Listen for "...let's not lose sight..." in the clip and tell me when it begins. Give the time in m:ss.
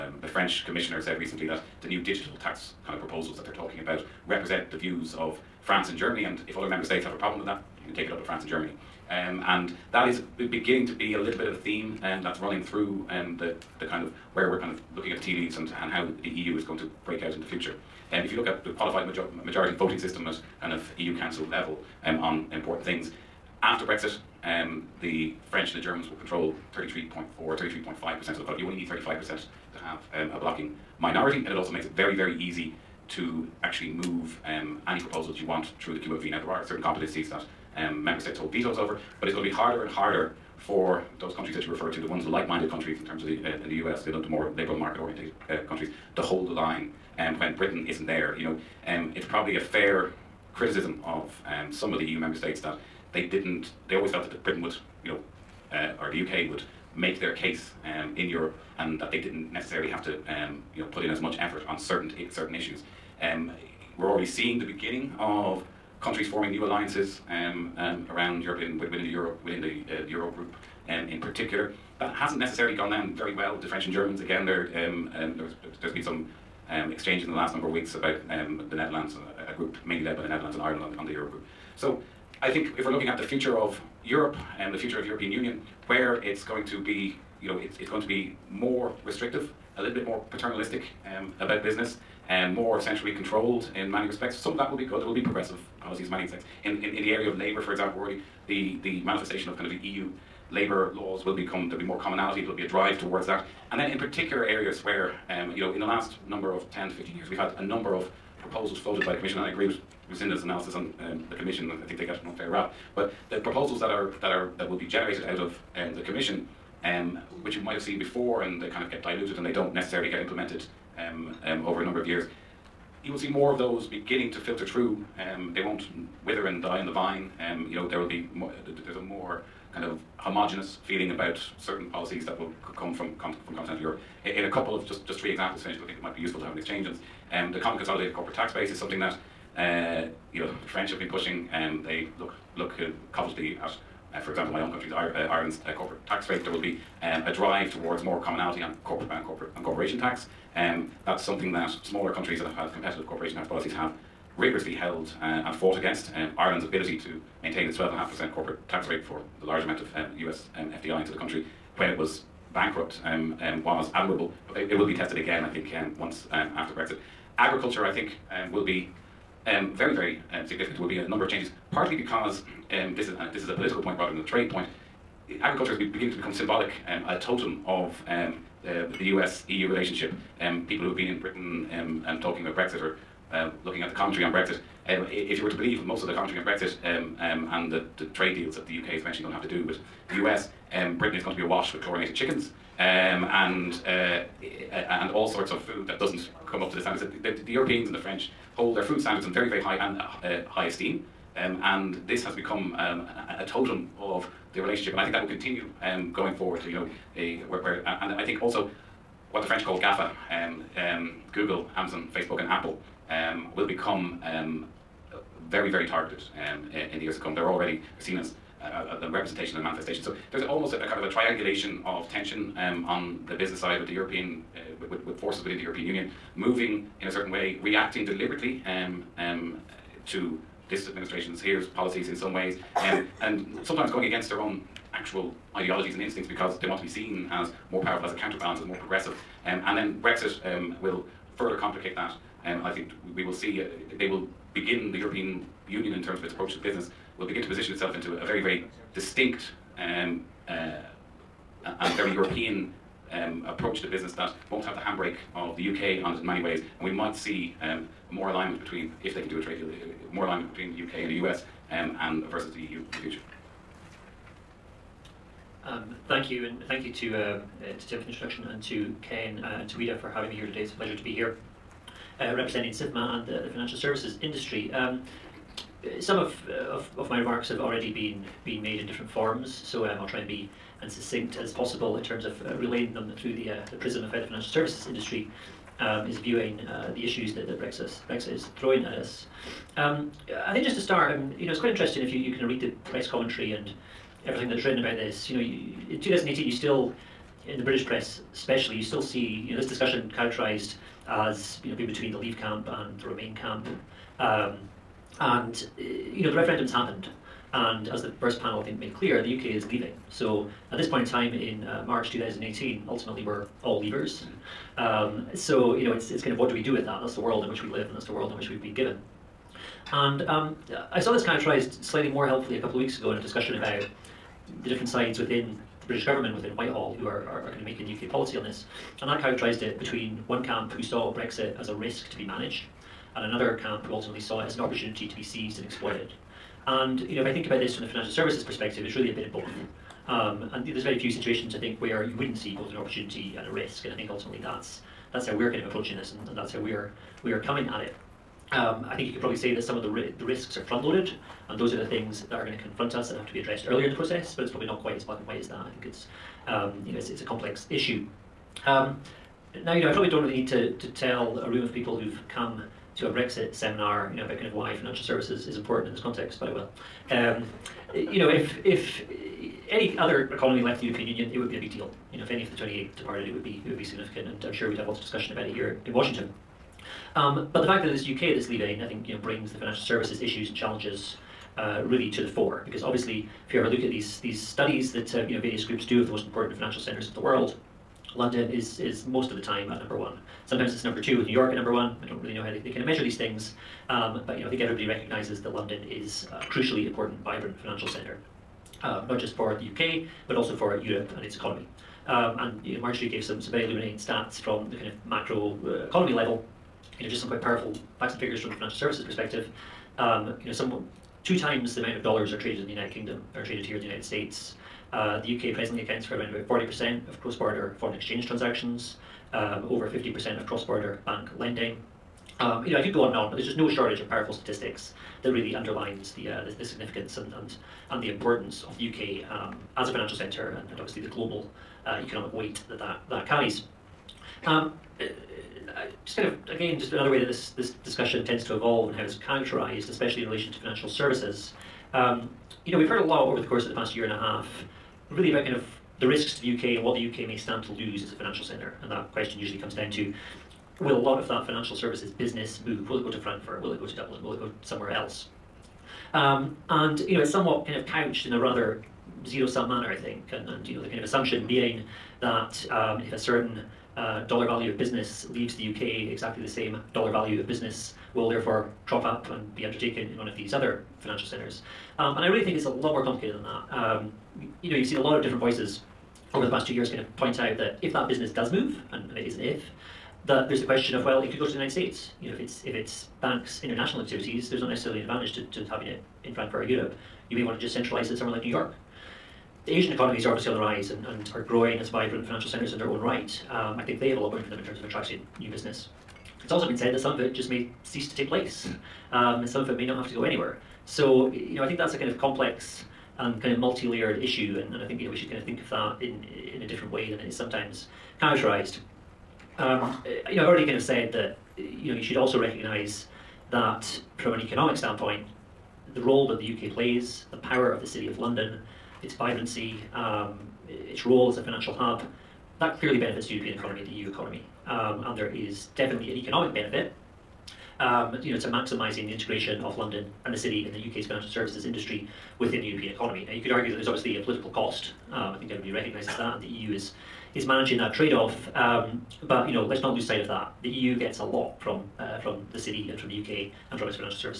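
8:59.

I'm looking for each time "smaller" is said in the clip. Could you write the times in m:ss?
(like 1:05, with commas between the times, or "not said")
2:31.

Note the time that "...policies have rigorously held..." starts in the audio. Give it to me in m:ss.
2:33.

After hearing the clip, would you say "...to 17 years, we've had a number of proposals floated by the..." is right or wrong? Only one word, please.
wrong.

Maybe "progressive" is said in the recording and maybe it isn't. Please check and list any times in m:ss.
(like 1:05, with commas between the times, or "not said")
1:35, 3:58.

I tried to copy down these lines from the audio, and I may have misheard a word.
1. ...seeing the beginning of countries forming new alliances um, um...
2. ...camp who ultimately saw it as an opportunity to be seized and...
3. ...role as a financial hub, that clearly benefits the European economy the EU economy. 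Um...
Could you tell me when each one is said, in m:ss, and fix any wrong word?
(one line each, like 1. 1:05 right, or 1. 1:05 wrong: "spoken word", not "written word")
1. 1:04 right
2. 5:33 right
3. 8:41 right.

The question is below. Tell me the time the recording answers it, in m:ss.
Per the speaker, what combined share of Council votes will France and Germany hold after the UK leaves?
0:26.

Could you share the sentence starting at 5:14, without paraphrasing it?
Um, so you know, it's it's kind of what do we do with that?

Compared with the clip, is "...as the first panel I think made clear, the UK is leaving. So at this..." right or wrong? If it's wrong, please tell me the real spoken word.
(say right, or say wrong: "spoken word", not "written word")
right.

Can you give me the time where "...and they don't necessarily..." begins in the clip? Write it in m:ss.
1:59.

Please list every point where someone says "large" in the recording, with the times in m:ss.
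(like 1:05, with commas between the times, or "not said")
2:39.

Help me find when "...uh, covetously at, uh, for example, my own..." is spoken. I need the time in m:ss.
2:22.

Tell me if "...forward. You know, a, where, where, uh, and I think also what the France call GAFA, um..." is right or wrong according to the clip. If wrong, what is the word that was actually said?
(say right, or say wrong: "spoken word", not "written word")
wrong: "French", not "France".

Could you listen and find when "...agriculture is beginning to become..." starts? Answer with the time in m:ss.
2:55.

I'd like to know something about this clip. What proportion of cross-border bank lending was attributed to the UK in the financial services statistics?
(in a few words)
over 50%.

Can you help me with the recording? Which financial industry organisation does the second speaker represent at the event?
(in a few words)
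SIFMA.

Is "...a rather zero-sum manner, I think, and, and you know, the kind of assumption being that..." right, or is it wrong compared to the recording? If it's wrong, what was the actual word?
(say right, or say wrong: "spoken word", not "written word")
right.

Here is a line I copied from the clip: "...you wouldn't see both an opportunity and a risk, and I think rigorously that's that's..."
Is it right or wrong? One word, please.
wrong.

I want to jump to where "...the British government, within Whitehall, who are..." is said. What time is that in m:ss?
5:25.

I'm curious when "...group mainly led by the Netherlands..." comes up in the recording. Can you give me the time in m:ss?
1:19.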